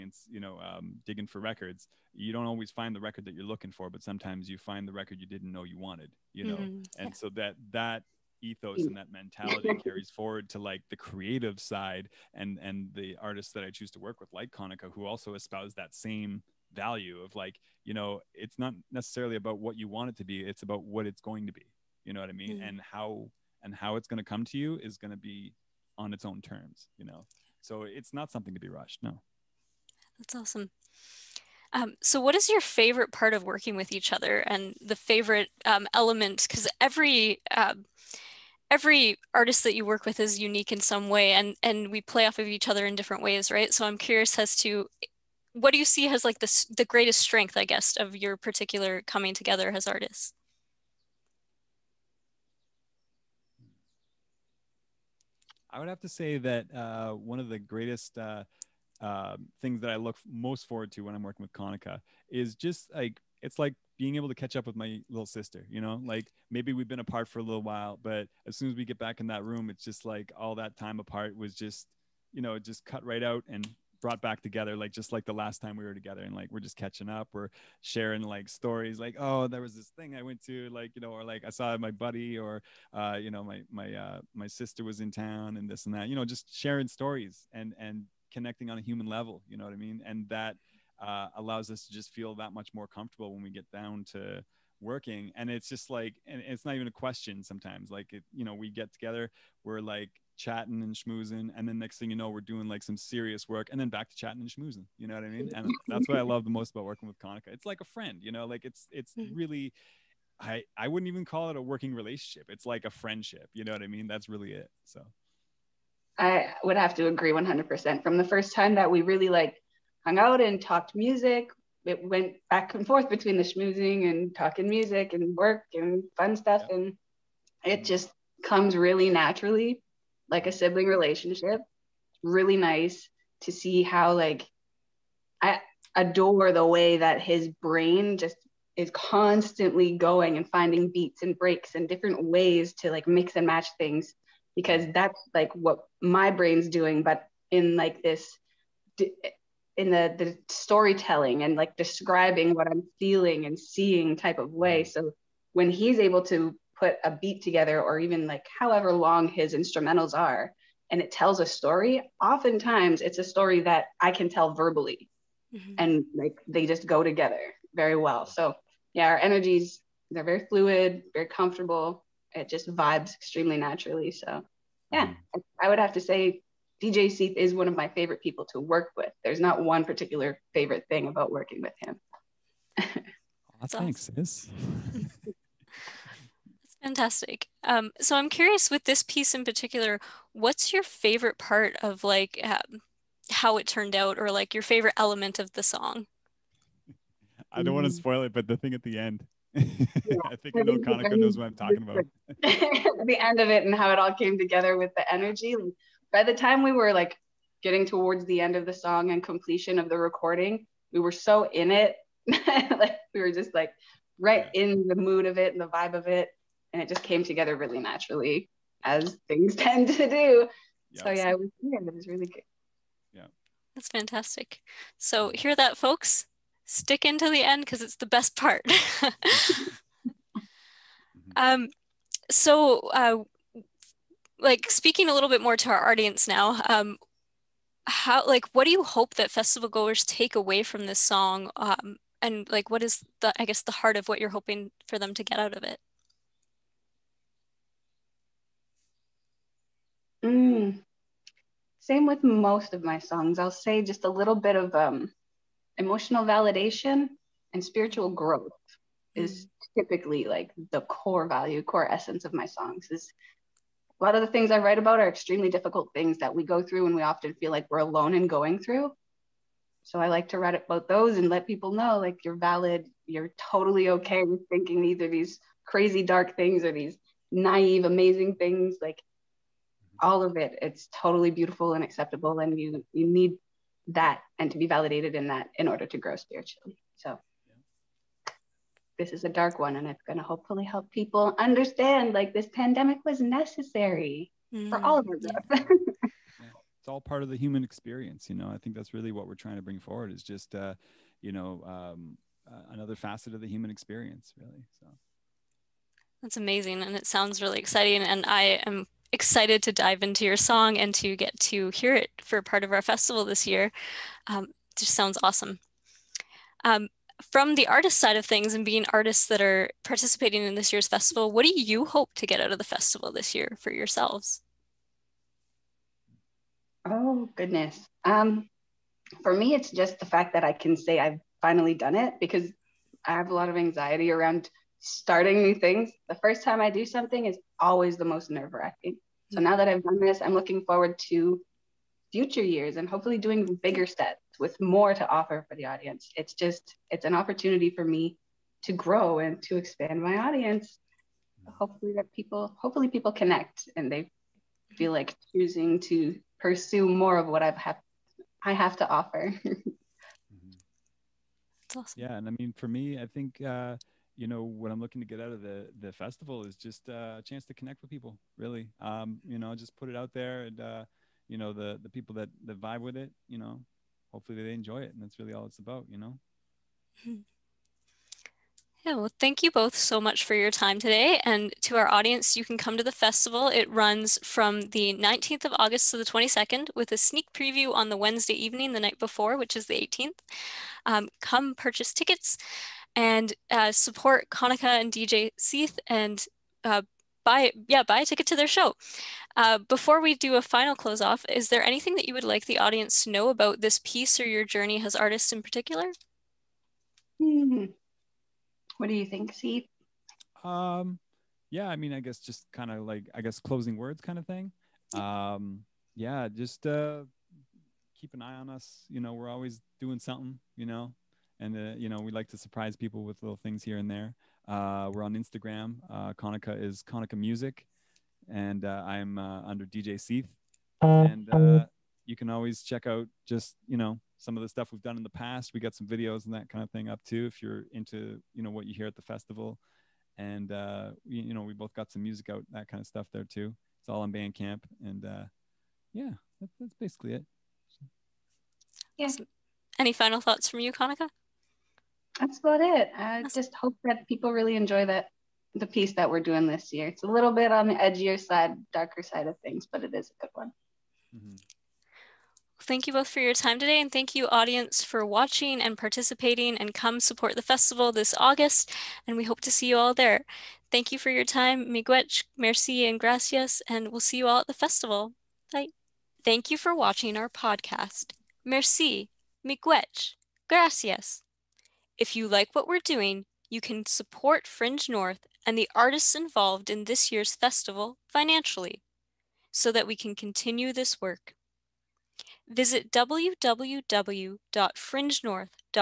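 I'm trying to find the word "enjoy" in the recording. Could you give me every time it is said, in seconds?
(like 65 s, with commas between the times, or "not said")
374 s, 454 s.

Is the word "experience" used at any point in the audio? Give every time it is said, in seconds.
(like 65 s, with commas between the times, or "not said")
297 s, 303 s.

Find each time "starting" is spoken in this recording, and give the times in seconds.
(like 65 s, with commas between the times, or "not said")
334 s.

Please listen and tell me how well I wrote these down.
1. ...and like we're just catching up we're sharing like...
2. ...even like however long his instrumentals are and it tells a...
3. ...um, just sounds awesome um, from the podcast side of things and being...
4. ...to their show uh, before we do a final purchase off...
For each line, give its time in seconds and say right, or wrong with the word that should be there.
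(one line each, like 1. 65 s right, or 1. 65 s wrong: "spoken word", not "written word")
1. 76 s right
2. 157 s right
3. 314 s wrong: "artist", not "podcast"
4. 398 s wrong: "close", not "purchase".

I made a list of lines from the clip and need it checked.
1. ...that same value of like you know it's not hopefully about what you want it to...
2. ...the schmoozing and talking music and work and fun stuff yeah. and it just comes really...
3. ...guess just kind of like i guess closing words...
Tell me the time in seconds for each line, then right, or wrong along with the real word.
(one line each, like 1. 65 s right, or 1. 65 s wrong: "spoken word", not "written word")
1. 15 s wrong: "necessarily", not "hopefully"
2. 123 s right
3. 411 s right.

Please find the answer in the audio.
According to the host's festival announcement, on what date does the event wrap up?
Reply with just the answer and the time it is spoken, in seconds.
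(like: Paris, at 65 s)
August 22, at 386 s.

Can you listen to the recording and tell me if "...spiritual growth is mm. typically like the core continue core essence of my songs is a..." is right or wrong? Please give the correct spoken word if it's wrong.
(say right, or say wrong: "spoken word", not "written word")
wrong: "value", not "continue".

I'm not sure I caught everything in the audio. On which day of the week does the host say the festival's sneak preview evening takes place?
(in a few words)
Wednesday.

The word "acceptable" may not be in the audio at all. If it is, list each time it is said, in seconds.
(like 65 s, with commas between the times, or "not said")
281 s.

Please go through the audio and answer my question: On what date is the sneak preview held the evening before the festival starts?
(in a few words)
August 18.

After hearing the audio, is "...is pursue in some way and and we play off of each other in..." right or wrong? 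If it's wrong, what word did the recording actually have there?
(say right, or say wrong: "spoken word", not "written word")
wrong: "unique", not "pursue".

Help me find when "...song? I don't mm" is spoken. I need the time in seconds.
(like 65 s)
195 s.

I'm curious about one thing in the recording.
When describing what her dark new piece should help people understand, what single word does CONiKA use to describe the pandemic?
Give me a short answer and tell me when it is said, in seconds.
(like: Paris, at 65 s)
necessary, at 293 s.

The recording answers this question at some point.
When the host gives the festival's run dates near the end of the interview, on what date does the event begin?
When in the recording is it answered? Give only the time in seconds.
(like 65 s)
384 s.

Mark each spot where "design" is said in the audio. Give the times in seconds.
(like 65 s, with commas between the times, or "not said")
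not said.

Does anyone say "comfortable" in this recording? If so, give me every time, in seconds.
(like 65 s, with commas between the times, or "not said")
92 s, 171 s.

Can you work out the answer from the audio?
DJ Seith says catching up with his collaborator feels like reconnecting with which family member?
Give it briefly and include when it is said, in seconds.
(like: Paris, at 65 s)
little sister, at 65 s.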